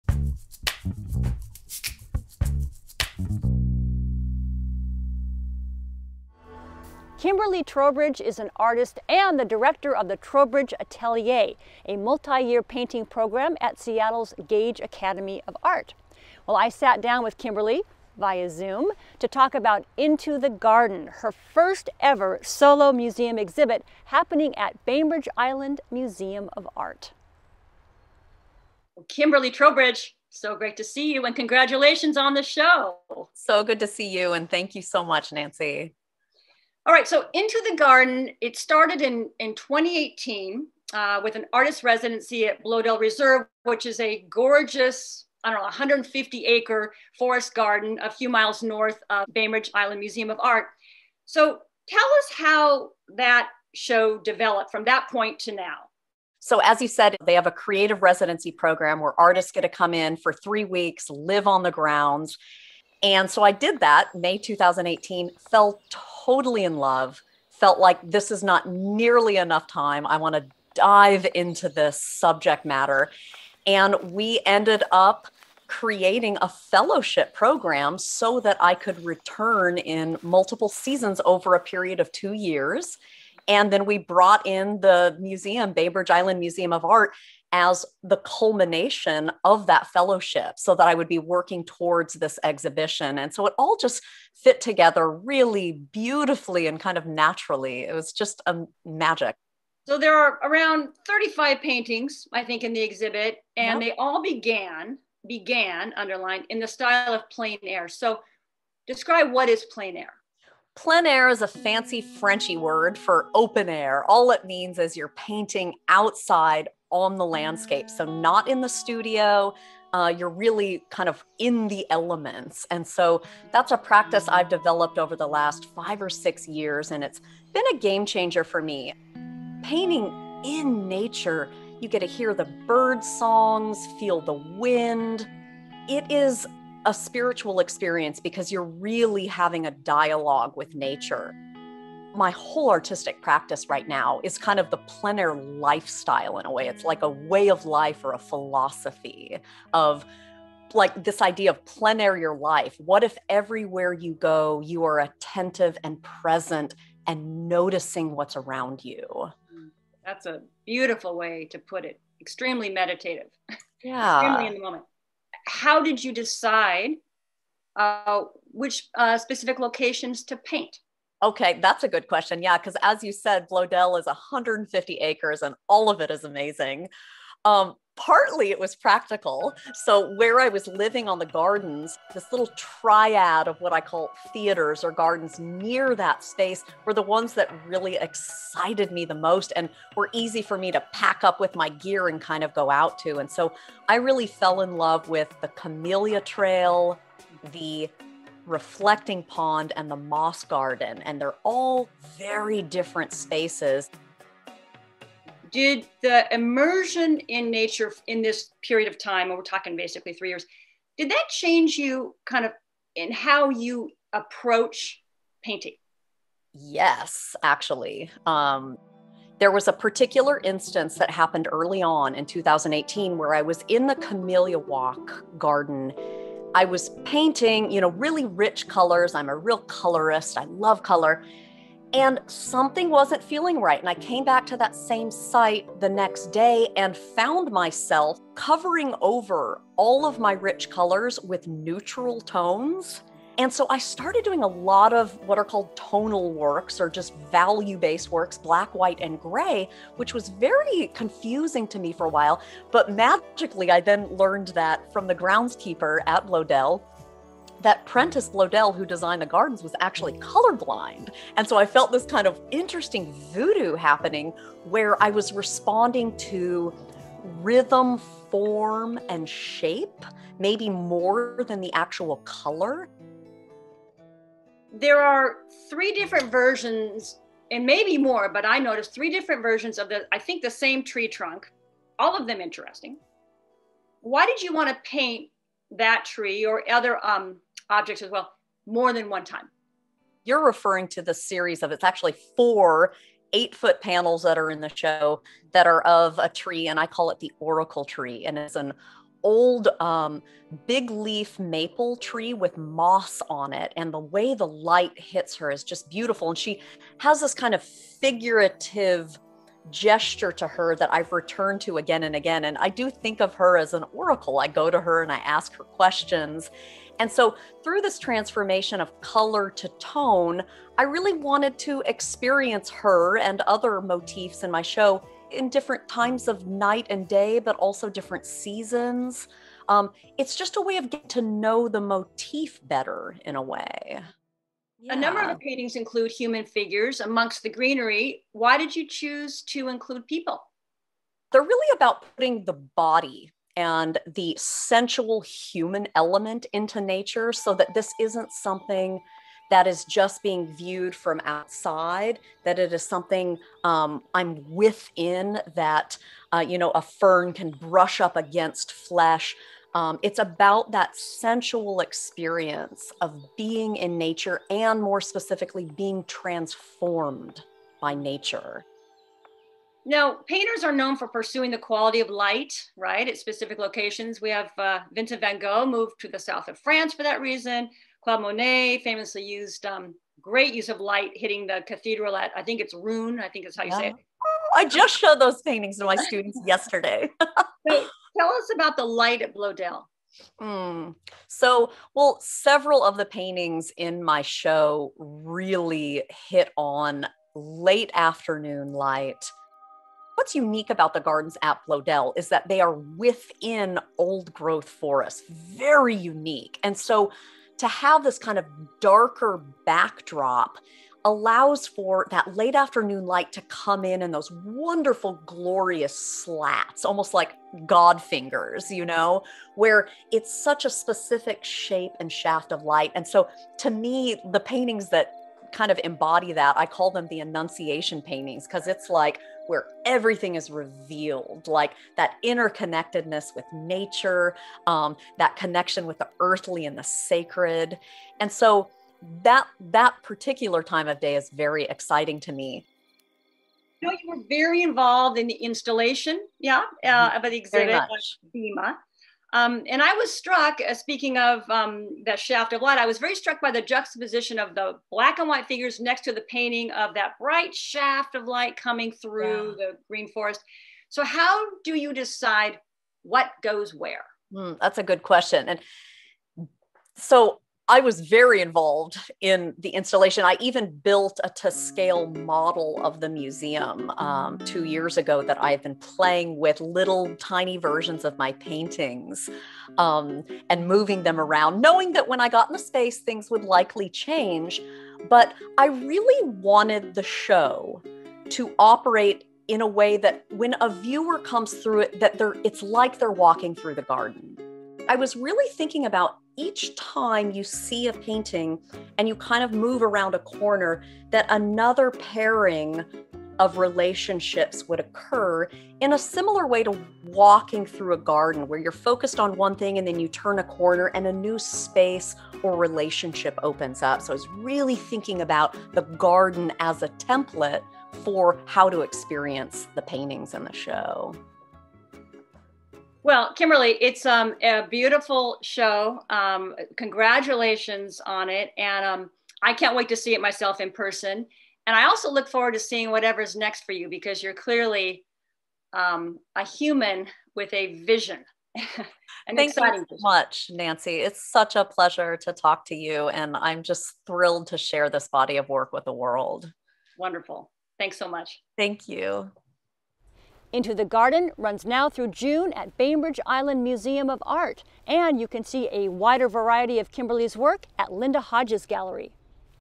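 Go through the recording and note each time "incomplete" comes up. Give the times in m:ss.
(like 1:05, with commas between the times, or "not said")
not said.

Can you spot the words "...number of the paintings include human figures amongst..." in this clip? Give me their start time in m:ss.
5:34.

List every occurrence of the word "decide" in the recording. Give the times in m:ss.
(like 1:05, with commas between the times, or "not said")
2:46, 7:41.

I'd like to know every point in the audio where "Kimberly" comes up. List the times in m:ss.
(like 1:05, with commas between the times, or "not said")
0:07, 0:17, 0:29, 8:43, 9:16.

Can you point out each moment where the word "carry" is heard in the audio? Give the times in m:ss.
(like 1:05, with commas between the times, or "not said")
not said.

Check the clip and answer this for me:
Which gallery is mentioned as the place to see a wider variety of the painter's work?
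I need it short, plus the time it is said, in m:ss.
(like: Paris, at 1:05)
Linda Hodges Gallery, at 9:17.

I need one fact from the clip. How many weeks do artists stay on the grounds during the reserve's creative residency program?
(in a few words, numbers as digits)
3.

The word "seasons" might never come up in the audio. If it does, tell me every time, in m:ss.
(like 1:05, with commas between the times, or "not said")
1:20, 5:28.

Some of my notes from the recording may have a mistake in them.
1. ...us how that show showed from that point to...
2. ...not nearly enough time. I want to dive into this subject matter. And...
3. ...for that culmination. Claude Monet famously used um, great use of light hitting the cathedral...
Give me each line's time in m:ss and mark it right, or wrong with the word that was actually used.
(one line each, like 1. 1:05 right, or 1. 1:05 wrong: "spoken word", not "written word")
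1. 0:51 wrong: "developed", not "showed"
2. 1:08 right
3. 6:16 wrong: "reason", not "culmination".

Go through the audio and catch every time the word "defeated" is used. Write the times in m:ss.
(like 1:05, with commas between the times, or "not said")
not said.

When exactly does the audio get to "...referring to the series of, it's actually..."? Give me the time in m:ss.
4:50.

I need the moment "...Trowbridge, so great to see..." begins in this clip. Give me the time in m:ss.
0:29.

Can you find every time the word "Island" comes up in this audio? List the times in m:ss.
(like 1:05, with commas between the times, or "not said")
0:25, 0:49, 1:26, 9:13.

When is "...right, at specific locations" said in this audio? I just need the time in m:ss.
6:12.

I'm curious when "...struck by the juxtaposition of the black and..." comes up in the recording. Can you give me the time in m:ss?
7:33.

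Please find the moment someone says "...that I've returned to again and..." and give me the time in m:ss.
5:10.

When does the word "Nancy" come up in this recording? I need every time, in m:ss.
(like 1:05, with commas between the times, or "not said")
0:35, 9:00.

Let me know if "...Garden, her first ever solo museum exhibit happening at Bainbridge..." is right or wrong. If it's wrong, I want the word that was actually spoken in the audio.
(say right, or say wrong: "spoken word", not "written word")
right.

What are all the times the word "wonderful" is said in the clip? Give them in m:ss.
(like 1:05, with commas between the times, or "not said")
6:54, 9:06.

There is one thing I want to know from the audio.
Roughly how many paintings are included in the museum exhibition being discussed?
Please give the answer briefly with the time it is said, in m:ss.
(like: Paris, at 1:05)
35, at 1:41.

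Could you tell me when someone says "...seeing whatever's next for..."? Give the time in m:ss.
8:52.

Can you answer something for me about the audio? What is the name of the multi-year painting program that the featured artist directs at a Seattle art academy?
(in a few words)
Trowbridge Atelier.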